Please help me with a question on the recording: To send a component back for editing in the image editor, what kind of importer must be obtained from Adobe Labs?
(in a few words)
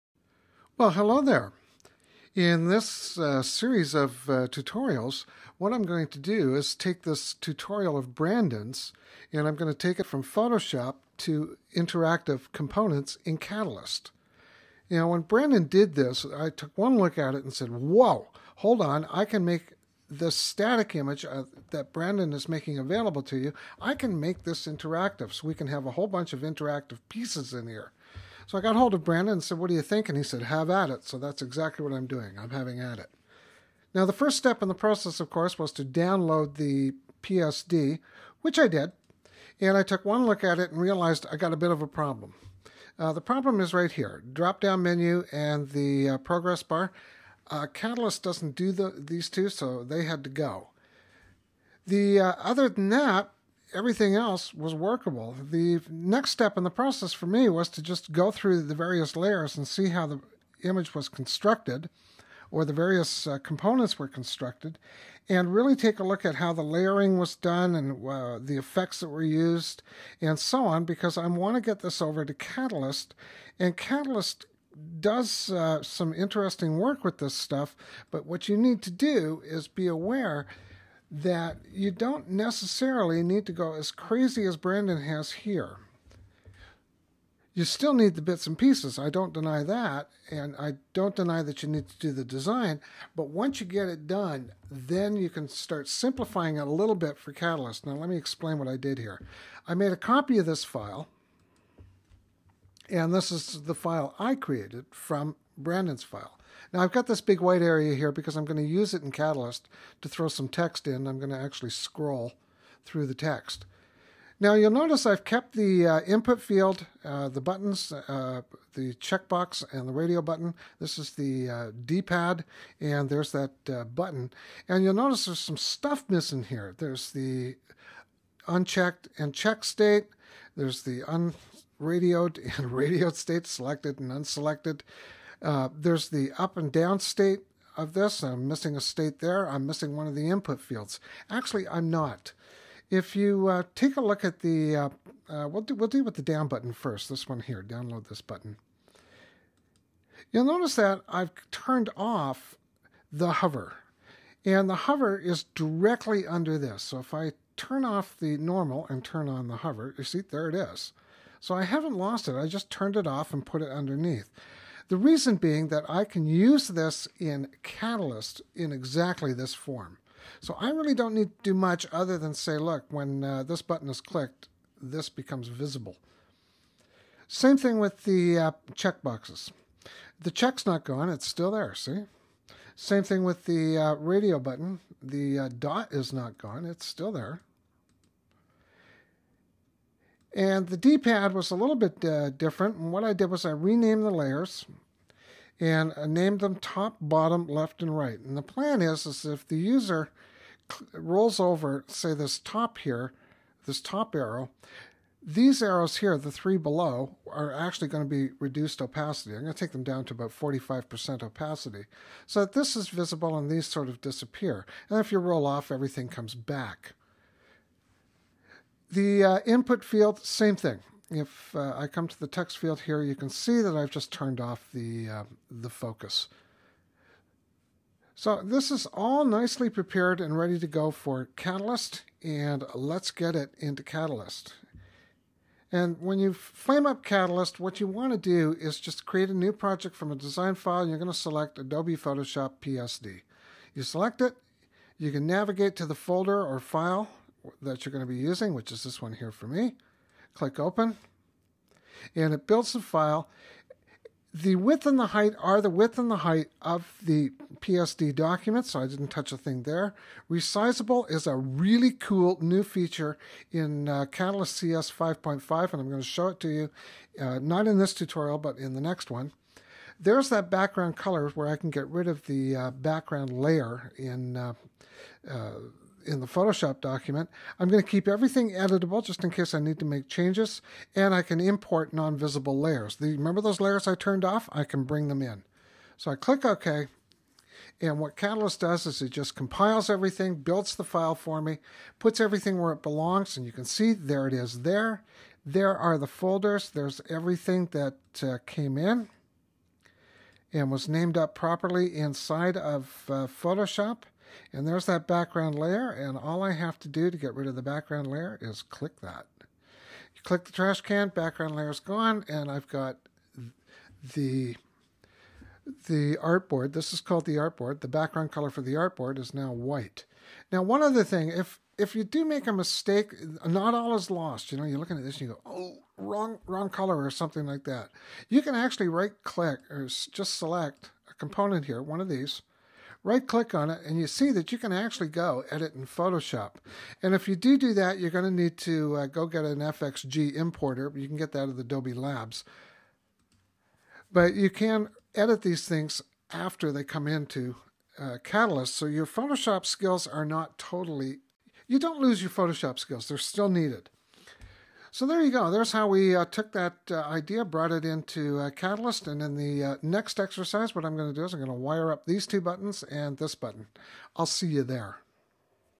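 FXG importer.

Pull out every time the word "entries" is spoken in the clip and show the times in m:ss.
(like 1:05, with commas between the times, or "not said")
not said.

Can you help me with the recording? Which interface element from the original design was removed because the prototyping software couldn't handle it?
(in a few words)
drop down menu.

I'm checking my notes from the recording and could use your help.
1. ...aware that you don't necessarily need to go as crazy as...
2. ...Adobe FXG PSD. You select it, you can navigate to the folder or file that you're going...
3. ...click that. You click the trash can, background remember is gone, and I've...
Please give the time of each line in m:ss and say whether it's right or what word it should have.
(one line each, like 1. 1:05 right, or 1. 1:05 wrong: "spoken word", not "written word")
1. 1:19 right
2. 4:01 wrong: "Photoshop", not "FXG"
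3. 5:08 wrong: "layer", not "remember".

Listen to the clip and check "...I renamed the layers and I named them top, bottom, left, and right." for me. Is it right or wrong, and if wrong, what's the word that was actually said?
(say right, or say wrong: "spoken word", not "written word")
right.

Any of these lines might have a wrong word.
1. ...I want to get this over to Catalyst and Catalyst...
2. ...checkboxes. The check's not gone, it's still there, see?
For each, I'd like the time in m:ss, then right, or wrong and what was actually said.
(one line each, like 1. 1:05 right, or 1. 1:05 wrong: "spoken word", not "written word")
1. 1:11 right
2. 2:58 right.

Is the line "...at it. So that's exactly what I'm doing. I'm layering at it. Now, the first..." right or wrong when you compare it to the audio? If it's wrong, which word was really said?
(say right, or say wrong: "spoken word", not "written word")
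wrong: "having", not "layering".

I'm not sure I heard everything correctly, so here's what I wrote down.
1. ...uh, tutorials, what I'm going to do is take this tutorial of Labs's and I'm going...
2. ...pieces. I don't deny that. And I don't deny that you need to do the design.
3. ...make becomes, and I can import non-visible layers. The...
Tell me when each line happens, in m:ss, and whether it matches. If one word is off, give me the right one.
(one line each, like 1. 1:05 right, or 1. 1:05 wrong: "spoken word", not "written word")
1. 0:04 wrong: "Brandon", not "Labs"
2. 1:28 right
3. 4:39 wrong: "changes", not "becomes".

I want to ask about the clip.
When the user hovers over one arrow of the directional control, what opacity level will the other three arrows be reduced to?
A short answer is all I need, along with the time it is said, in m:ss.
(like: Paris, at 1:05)
45%, at 3:30.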